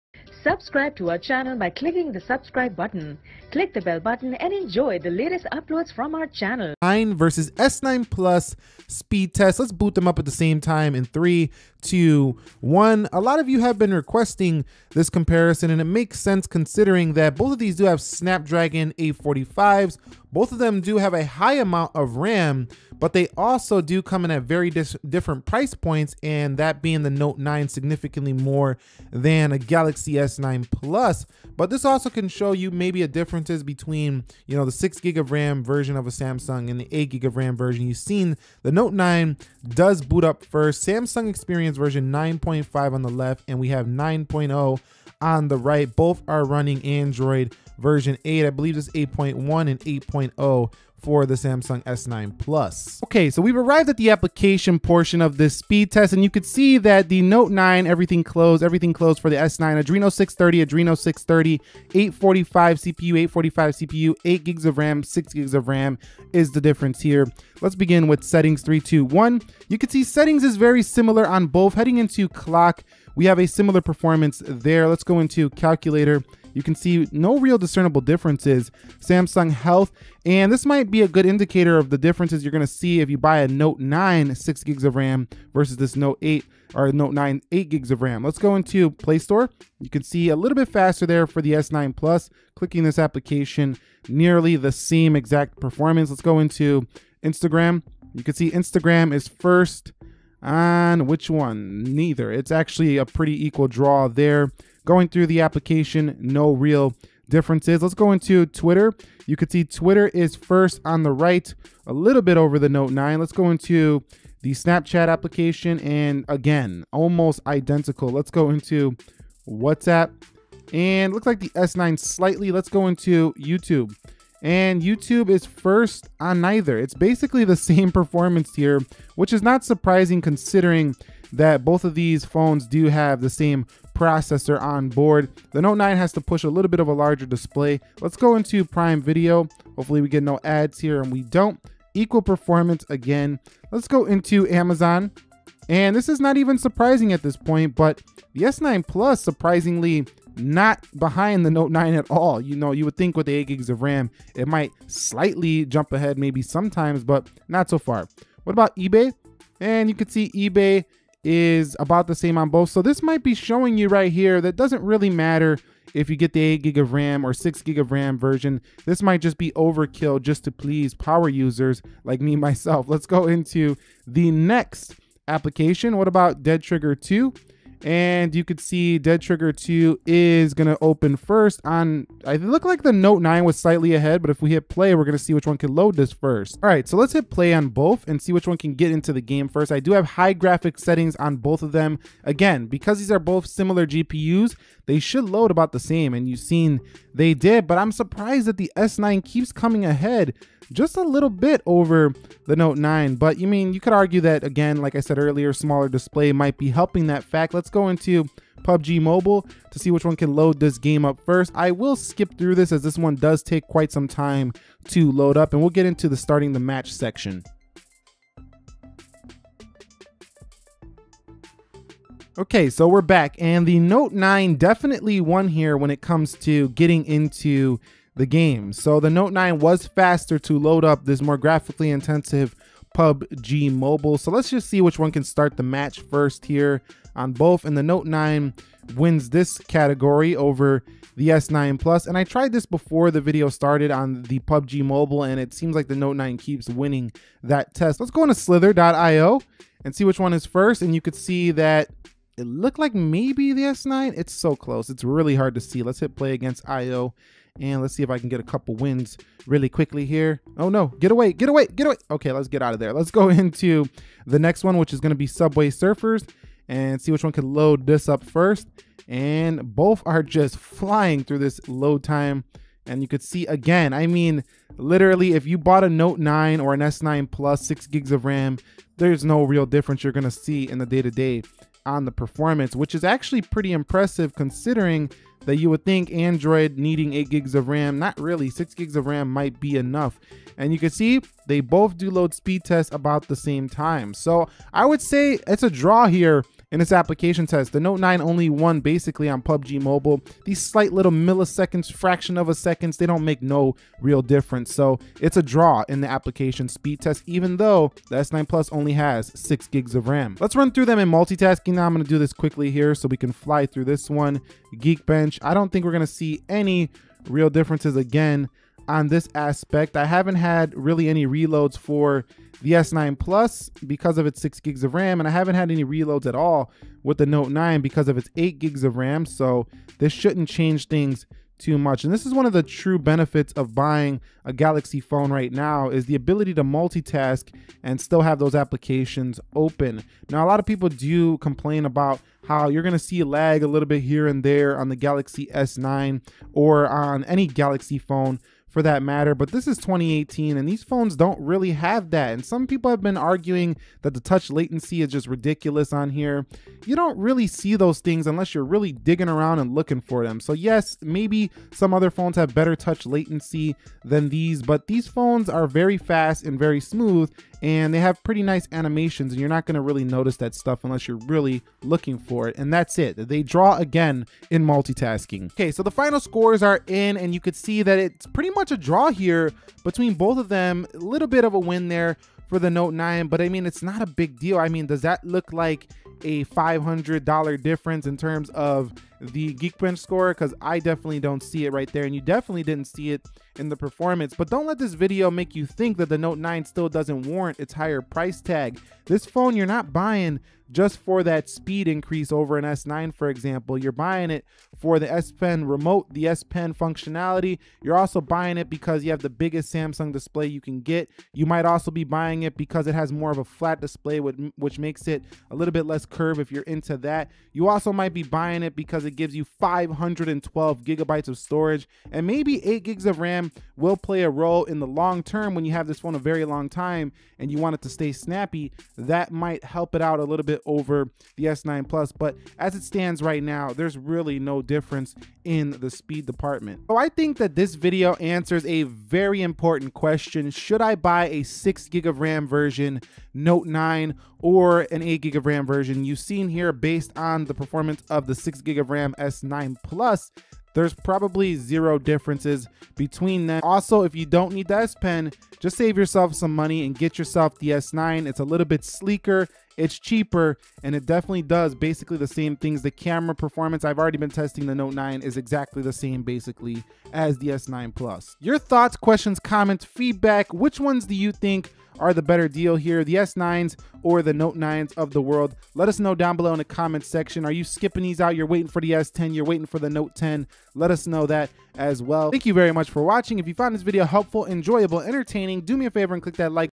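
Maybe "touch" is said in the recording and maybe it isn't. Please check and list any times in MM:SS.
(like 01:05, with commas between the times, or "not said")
05:54, 06:02.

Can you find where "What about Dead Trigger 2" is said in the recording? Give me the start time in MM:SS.
02:55.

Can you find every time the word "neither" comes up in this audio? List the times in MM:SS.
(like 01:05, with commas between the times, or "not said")
01:41, 02:06.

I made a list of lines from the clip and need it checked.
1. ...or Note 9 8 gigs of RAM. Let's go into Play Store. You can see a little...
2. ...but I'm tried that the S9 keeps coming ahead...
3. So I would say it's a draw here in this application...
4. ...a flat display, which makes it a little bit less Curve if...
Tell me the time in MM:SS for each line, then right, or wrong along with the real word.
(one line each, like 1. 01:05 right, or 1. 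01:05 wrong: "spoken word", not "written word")
1. 01:26 right
2. 03:17 wrong: "surprised", not "tried"
3. 04:54 right
4. 06:53 right.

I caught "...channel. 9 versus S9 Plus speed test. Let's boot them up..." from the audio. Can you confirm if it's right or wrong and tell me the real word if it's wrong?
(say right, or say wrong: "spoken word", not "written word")
right.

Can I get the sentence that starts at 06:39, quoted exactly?
This phone you're not buying just for that speed increase over an S9, for example.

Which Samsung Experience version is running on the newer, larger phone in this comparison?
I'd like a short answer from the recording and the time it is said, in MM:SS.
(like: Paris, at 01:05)
9.5, at 00:40.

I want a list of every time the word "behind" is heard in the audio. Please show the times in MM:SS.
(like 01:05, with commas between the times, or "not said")
02:30.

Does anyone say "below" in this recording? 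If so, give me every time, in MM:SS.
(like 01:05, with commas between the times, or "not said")
07:56.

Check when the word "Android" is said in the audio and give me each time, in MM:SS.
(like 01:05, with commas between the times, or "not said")
00:46, 04:46.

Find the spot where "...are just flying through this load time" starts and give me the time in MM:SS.
04:30.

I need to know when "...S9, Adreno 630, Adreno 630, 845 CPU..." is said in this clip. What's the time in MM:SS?
00:59.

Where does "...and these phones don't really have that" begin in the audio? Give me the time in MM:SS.
05:50.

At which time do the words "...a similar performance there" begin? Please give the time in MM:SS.
01:13.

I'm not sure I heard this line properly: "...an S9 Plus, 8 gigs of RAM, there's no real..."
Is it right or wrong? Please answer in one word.
wrong.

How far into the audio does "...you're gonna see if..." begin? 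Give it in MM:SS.
01:22.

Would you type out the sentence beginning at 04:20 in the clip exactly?
Oh no, get away, get away, get away.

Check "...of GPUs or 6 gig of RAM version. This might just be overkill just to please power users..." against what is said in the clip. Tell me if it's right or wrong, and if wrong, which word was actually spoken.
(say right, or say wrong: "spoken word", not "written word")
wrong: "RAM", not "GPUs".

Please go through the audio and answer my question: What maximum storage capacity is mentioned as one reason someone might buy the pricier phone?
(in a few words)
512 gigabytes.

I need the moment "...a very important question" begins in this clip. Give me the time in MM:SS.
07:18.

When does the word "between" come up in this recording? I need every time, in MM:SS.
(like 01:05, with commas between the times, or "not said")
00:33, 06:19, 07:32.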